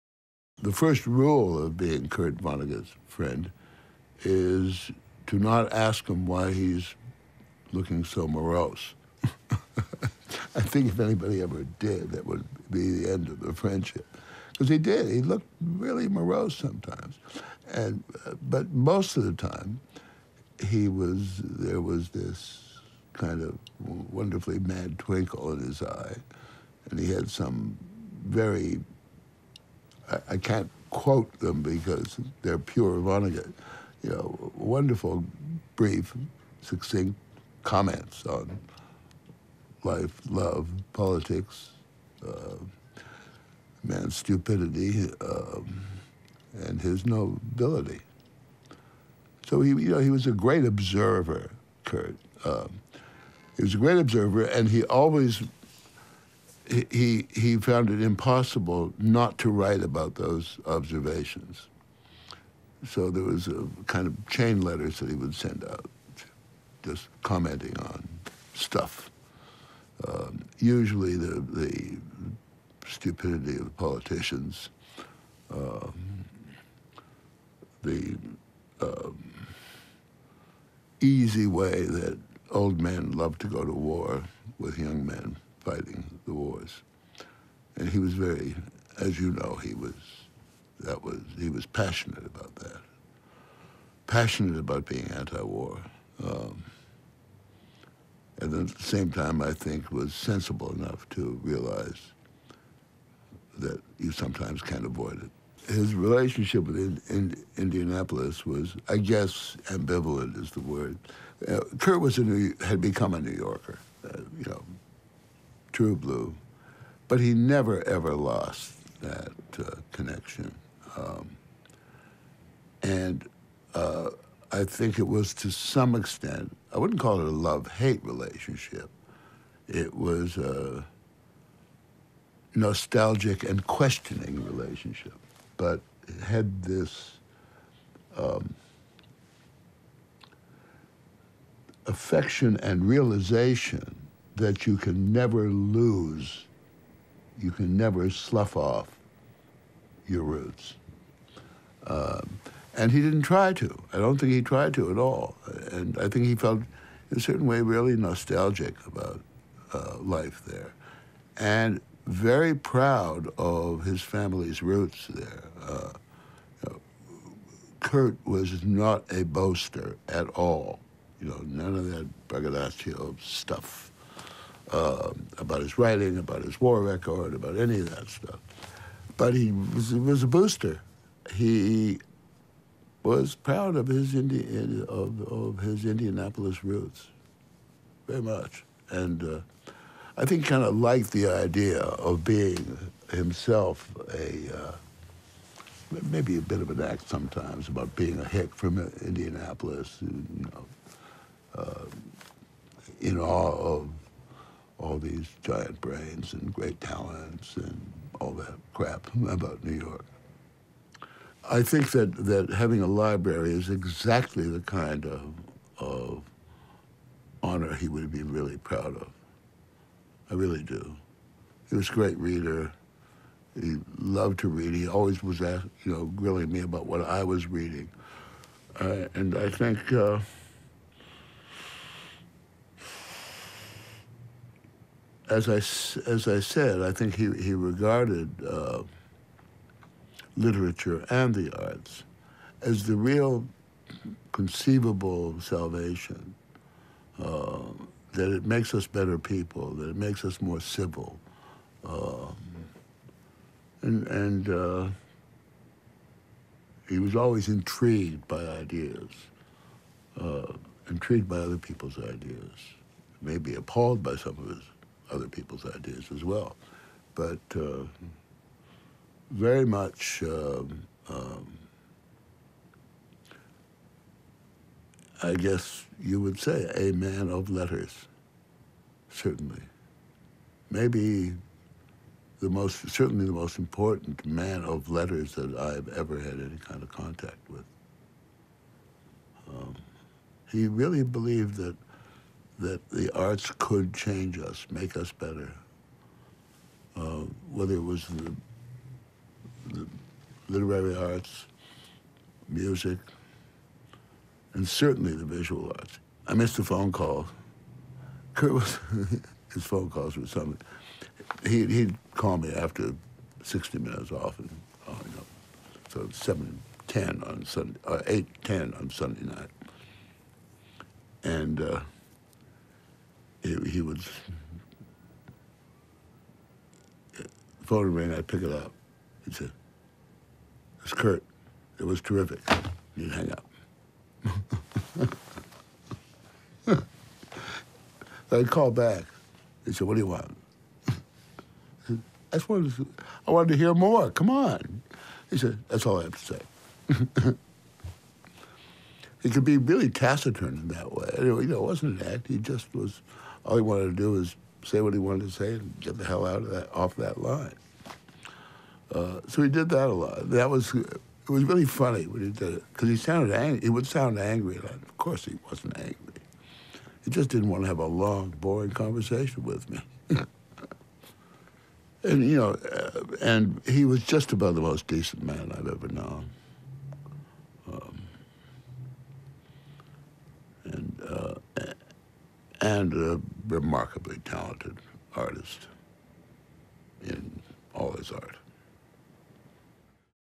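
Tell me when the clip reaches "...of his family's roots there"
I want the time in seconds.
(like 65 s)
163 s.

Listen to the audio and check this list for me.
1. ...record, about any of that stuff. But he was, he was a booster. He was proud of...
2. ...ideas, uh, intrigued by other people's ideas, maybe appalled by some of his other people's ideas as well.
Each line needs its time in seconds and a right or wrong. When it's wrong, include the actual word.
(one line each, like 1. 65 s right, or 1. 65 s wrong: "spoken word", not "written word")
1. 176 s right
2. 258 s right.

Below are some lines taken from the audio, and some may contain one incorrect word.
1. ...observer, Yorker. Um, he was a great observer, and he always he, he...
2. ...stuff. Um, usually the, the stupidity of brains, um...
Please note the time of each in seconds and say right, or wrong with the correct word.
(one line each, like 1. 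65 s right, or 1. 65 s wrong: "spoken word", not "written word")
1. 50 s wrong: "Kurt", not "Yorker"
2. 68 s wrong: "politicians", not "brains".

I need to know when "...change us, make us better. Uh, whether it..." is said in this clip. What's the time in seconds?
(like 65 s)
293 s.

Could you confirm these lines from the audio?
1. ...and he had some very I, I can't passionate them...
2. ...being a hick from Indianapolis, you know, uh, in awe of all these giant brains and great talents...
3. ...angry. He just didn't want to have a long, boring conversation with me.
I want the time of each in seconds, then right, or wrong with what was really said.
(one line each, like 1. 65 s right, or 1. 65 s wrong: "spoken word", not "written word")
1. 26 s wrong: "quote", not "passionate"
2. 197 s right
3. 365 s right.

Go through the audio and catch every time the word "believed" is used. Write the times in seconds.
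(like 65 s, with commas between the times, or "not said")
291 s.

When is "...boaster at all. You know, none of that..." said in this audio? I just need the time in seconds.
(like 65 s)
169 s.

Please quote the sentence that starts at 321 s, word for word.
And uh, it, he would phone ring, I'd pick it up.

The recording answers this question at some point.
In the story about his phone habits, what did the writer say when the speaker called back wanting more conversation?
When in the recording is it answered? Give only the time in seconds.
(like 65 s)
345 s.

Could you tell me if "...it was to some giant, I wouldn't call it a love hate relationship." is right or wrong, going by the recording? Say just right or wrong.
wrong.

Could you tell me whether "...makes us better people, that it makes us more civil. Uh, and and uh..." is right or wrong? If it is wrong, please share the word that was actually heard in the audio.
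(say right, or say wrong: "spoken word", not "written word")
right.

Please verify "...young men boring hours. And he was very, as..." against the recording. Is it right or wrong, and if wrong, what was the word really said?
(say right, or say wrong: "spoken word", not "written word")
wrong: "fighting", not "boring".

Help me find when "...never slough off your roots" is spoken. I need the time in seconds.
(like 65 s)
147 s.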